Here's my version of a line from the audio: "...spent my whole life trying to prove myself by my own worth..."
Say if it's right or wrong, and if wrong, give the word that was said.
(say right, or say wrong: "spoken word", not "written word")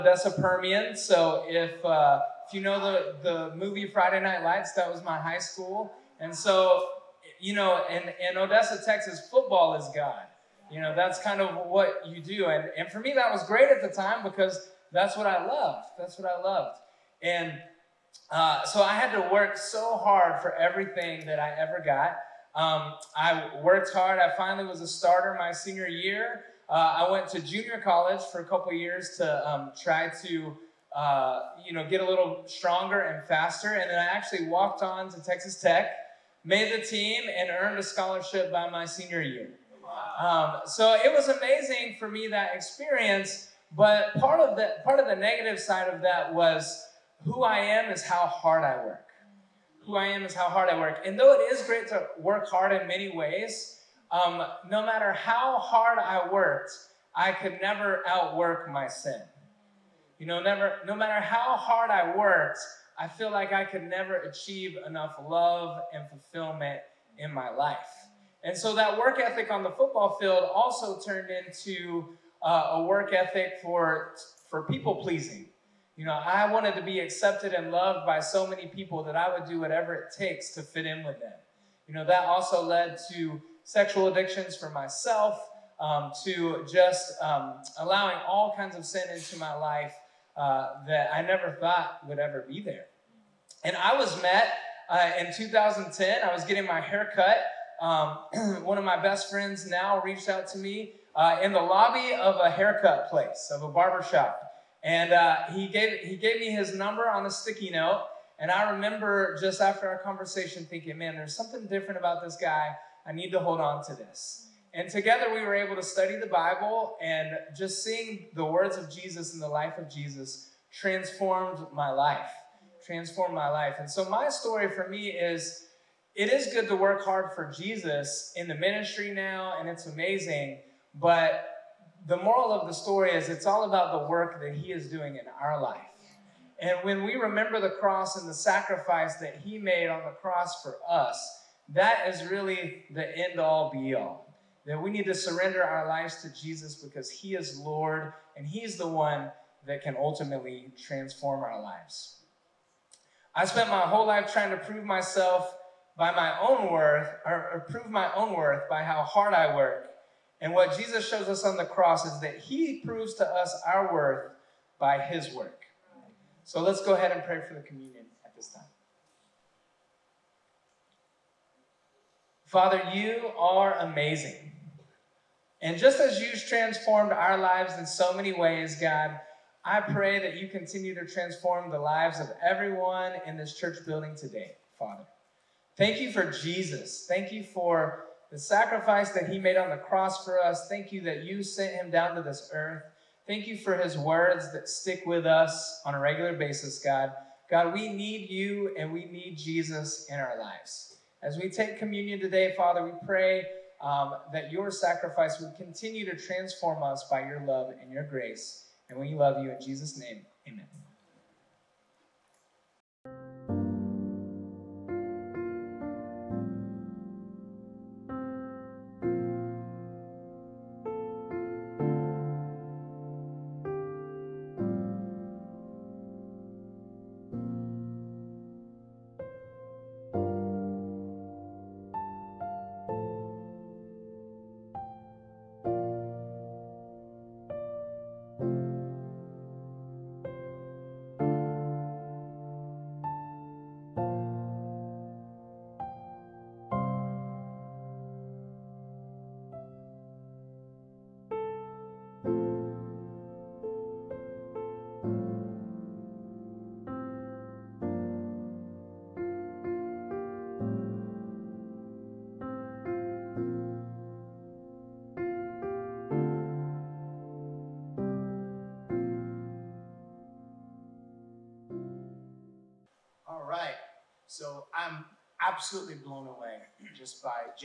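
right.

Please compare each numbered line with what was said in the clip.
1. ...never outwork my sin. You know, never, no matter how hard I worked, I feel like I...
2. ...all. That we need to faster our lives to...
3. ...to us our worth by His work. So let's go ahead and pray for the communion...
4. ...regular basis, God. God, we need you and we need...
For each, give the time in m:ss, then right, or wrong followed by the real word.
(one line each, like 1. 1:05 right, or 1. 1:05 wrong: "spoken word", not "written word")
1. 0:57 right
2. 2:23 wrong: "surrender", not "faster"
3. 2:43 right
4. 3:15 right.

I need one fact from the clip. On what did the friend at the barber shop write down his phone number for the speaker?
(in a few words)
a sticky note.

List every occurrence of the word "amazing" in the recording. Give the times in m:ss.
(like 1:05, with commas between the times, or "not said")
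0:41, 2:09, 2:53.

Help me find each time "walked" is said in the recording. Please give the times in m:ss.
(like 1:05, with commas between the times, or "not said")
0:34.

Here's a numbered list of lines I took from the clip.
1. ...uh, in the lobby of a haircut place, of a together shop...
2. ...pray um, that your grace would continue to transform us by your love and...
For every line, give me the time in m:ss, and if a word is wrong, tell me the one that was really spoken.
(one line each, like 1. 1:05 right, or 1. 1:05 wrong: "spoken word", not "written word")
1. 1:41 wrong: "barber", not "together"
2. 3:23 wrong: "sacrifice", not "grace".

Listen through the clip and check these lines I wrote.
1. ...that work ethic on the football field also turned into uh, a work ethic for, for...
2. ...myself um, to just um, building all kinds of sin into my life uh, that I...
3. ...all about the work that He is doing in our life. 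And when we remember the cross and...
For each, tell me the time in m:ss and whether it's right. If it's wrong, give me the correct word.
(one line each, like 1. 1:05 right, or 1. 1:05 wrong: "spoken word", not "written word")
1. 1:08 right
2. 1:24 wrong: "allowing", not "building"
3. 2:13 right.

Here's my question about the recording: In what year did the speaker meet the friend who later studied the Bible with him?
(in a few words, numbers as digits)
2010.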